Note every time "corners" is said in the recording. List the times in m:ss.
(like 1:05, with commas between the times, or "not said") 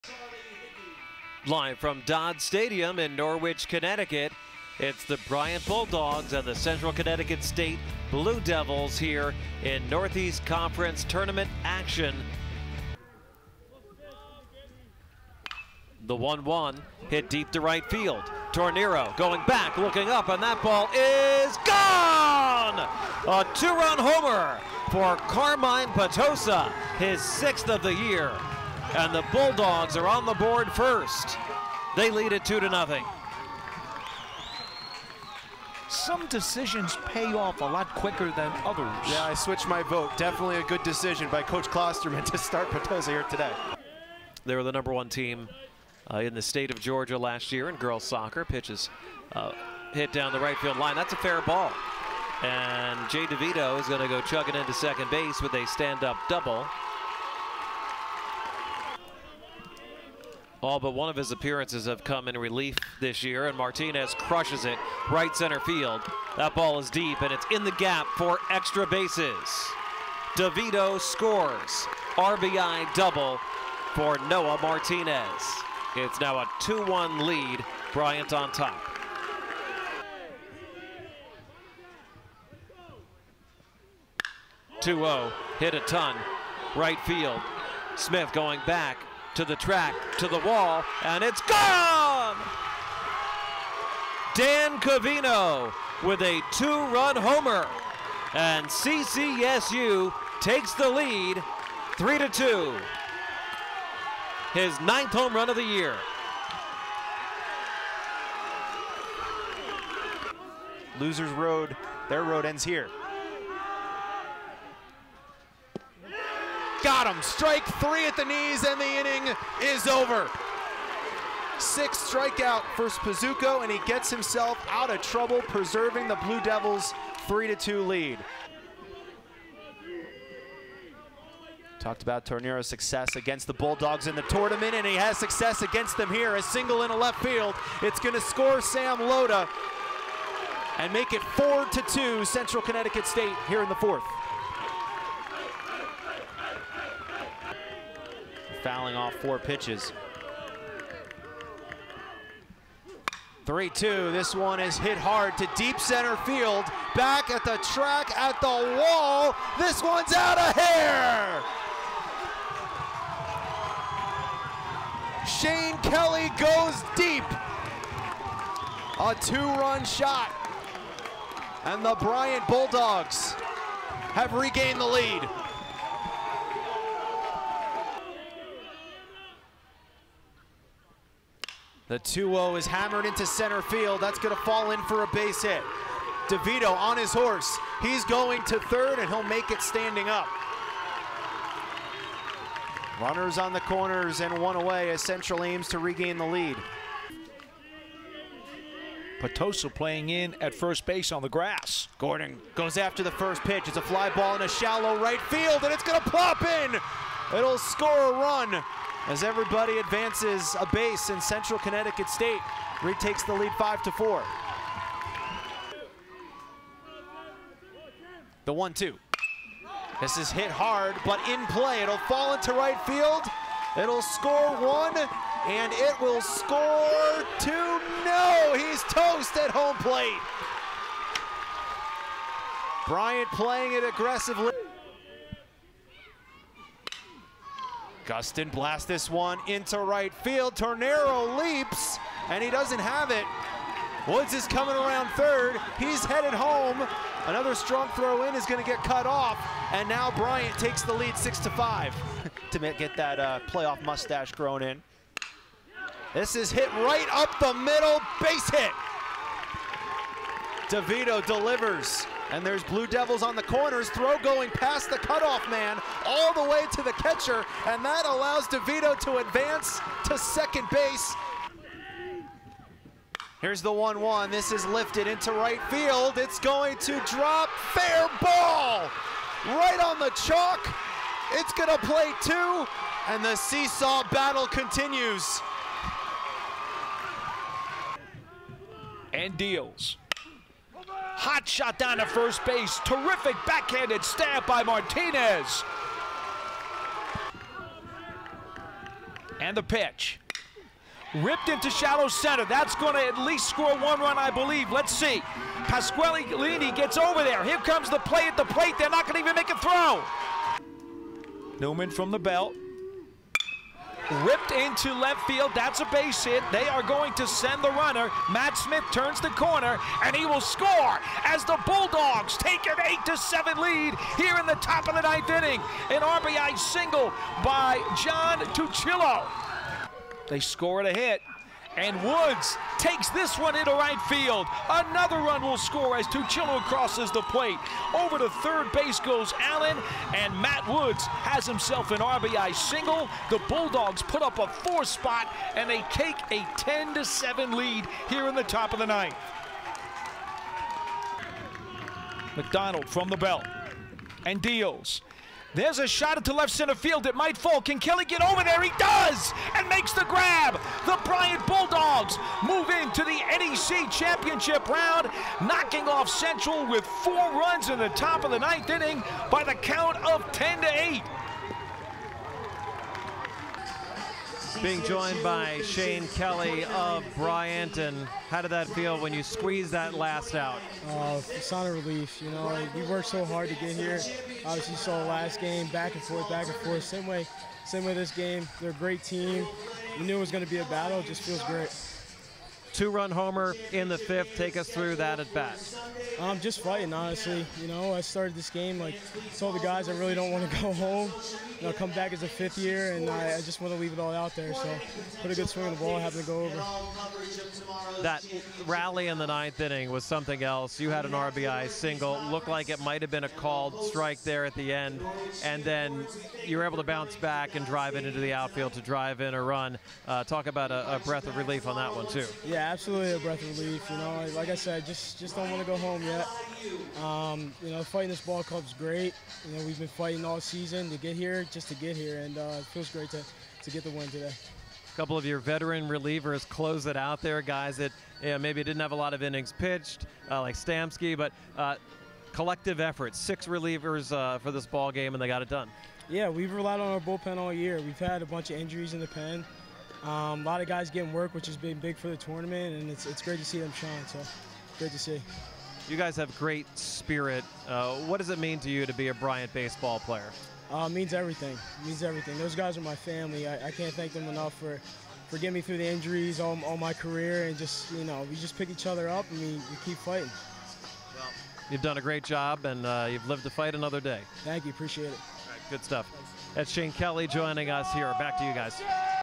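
3:13, 4:23, 5:19.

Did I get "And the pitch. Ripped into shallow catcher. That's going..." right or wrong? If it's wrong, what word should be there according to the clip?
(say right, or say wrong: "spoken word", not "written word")
wrong: "center", not "catcher".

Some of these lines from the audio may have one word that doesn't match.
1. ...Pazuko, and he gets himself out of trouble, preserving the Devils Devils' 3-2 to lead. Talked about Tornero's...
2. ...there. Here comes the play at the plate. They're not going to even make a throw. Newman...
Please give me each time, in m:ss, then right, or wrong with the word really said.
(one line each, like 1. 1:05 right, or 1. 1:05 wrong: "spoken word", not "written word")
1. 2:02 wrong: "Blue", not "Devils"
2. 5:07 right.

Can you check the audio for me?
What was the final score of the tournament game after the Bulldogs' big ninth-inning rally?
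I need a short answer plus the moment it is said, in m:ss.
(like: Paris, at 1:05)
10 to 8, at 6:10.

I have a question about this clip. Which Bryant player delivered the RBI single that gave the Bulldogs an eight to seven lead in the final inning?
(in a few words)
John Tuchillo.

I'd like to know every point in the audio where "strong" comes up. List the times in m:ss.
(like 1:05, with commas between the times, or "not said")
4:07.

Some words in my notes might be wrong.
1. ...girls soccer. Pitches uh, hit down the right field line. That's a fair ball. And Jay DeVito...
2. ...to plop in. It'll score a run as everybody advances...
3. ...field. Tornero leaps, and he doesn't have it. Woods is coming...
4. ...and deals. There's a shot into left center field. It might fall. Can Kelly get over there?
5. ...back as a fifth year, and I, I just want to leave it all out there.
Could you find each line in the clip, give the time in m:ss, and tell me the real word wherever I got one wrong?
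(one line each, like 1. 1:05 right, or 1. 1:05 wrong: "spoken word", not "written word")
1. 0:47 right
2. 3:26 right
3. 4:00 right
4. 5:54 right
5. 6:41 right.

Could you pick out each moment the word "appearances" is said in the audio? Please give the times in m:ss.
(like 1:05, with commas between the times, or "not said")
1:01.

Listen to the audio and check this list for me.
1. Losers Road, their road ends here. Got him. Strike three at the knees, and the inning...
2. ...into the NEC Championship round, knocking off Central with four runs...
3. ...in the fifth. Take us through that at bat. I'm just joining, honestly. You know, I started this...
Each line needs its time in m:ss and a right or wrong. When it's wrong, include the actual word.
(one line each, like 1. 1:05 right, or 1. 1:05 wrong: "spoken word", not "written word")
1. 1:50 right
2. 6:02 right
3. 6:33 wrong: "fighting", not "joining".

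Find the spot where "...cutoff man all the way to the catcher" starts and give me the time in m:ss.
4:24.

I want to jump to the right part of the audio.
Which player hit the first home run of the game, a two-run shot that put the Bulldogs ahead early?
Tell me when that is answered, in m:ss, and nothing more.
0:25.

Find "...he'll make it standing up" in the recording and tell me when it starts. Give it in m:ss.
3:09.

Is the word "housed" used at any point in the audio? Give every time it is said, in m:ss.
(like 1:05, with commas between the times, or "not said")
not said.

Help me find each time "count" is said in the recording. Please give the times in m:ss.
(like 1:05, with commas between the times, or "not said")
6:09.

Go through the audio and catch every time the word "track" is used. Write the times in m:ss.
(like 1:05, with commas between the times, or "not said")
1:29, 2:37.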